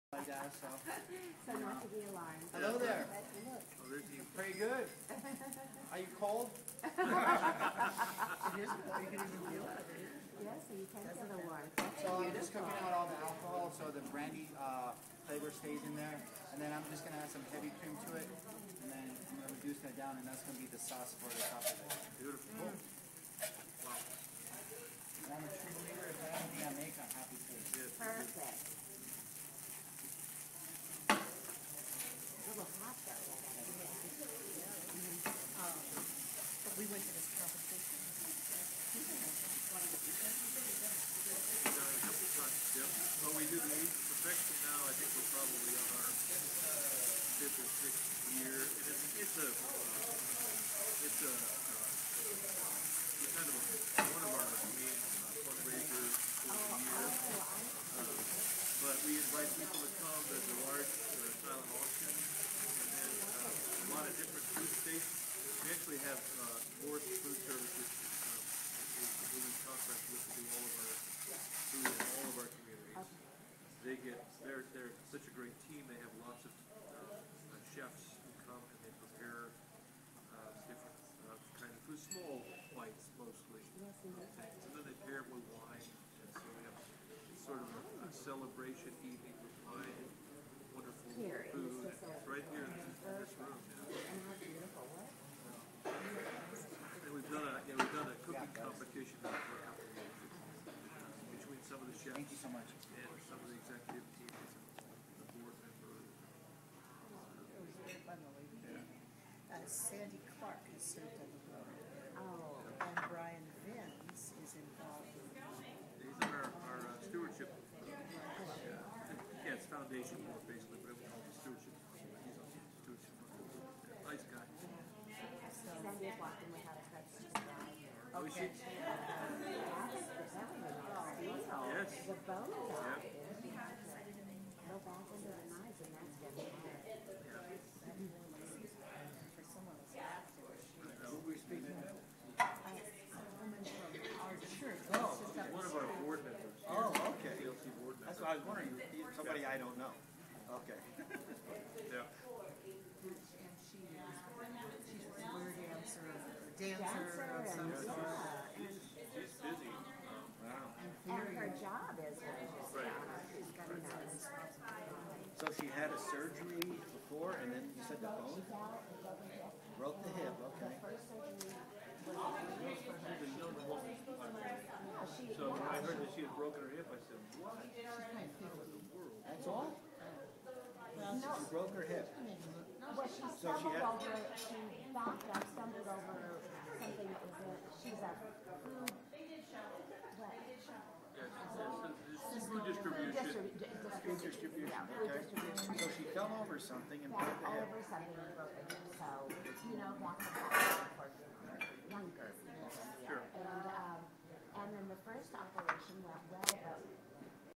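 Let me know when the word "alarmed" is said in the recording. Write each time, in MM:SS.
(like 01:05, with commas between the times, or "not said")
00:02.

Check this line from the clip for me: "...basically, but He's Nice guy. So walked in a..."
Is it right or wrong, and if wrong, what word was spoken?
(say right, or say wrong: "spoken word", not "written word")
right.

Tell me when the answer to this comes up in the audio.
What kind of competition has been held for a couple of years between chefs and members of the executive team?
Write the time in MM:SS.
01:38.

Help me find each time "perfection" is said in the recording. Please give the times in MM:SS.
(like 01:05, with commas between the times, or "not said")
00:44.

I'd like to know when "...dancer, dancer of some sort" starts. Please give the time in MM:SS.
02:36.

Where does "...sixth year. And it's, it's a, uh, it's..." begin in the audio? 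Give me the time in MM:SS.
00:47.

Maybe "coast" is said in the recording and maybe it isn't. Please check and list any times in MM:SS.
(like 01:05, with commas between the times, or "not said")
not said.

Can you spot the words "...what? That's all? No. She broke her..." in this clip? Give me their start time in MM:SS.
02:57.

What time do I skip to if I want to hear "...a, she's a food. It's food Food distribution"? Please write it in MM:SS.
03:07.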